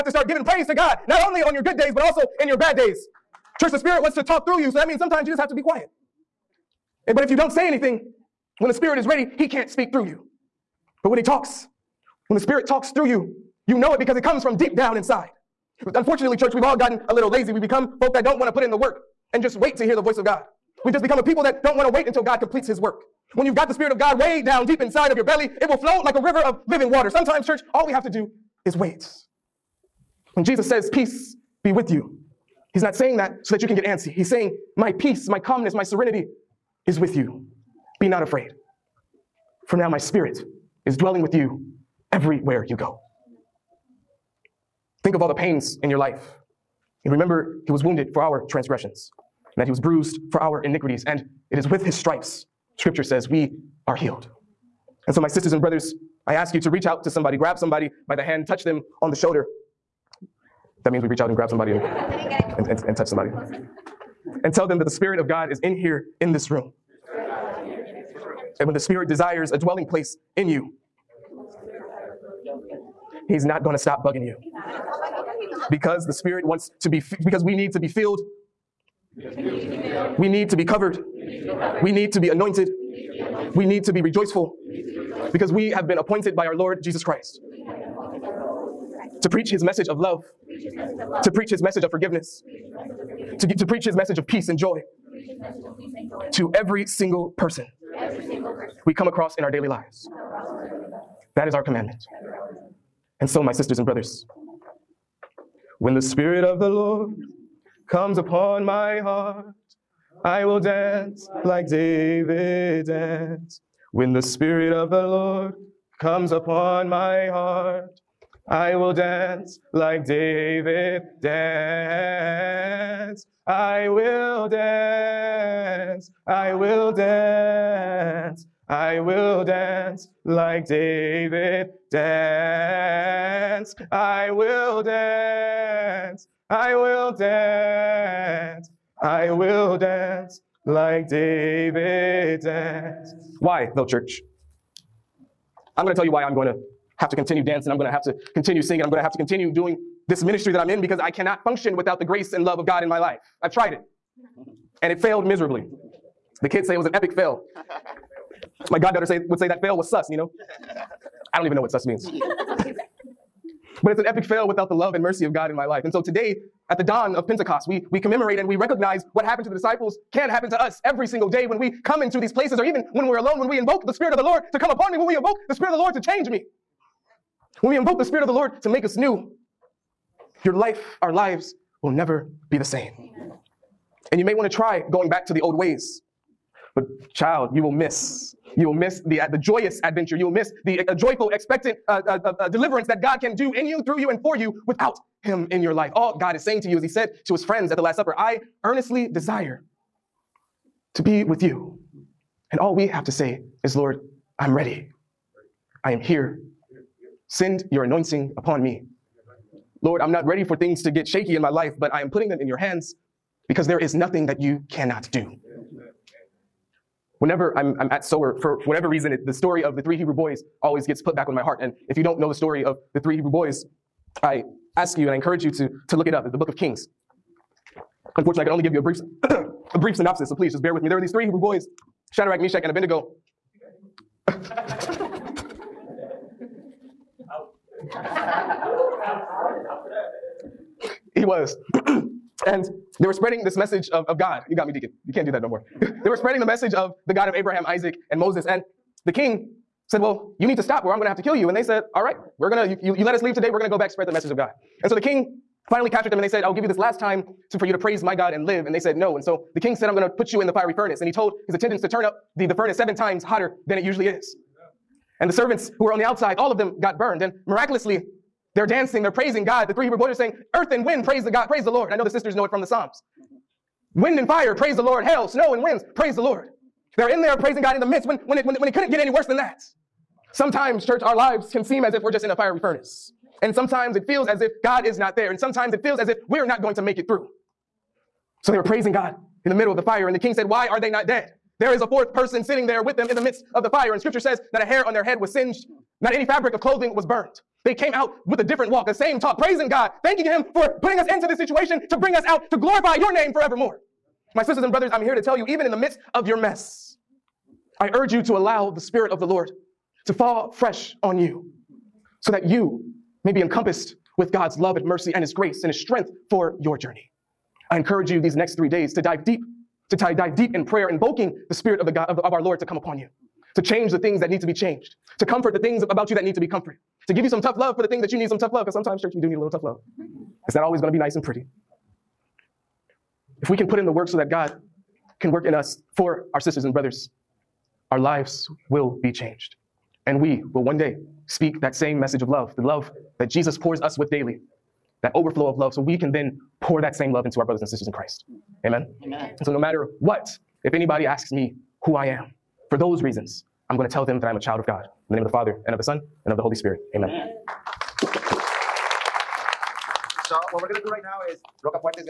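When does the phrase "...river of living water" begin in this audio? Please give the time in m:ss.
0:26.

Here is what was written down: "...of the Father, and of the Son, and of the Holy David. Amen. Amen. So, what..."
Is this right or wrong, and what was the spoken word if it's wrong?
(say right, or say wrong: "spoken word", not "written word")
wrong: "Spirit", not "David".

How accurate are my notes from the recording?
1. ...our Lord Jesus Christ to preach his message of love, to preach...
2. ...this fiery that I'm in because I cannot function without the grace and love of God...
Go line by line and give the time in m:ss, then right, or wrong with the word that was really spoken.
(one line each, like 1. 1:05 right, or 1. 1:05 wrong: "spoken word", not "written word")
1. 1:26 right
2. 2:30 wrong: "ministry", not "fiery".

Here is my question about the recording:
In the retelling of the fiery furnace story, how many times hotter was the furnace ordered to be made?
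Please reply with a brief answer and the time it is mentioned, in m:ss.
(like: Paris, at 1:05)
7, at 4:22.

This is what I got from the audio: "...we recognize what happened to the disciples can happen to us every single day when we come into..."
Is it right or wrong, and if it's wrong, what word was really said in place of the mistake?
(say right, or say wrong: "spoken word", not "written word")
right.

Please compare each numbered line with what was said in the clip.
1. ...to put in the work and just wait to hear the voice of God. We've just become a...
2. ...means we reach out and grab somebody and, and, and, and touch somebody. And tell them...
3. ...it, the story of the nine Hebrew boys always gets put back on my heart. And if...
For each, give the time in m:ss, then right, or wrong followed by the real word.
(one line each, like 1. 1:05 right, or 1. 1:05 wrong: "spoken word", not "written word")
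1. 0:18 right
2. 1:00 right
3. 3:39 wrong: "three", not "nine".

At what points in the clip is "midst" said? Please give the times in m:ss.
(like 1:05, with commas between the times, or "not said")
4:37, 4:53, 5:05.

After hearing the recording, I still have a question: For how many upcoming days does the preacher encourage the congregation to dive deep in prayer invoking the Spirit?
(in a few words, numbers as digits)
3.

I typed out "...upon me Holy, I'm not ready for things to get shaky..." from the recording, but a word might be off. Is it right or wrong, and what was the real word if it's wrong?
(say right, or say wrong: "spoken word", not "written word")
wrong: "Lord", not "Holy".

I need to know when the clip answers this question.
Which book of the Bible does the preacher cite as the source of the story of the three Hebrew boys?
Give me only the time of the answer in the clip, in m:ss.
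3:46.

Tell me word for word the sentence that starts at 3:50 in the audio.
There were these three Hebrew boys, Shadrach, Meshach, and Abednego.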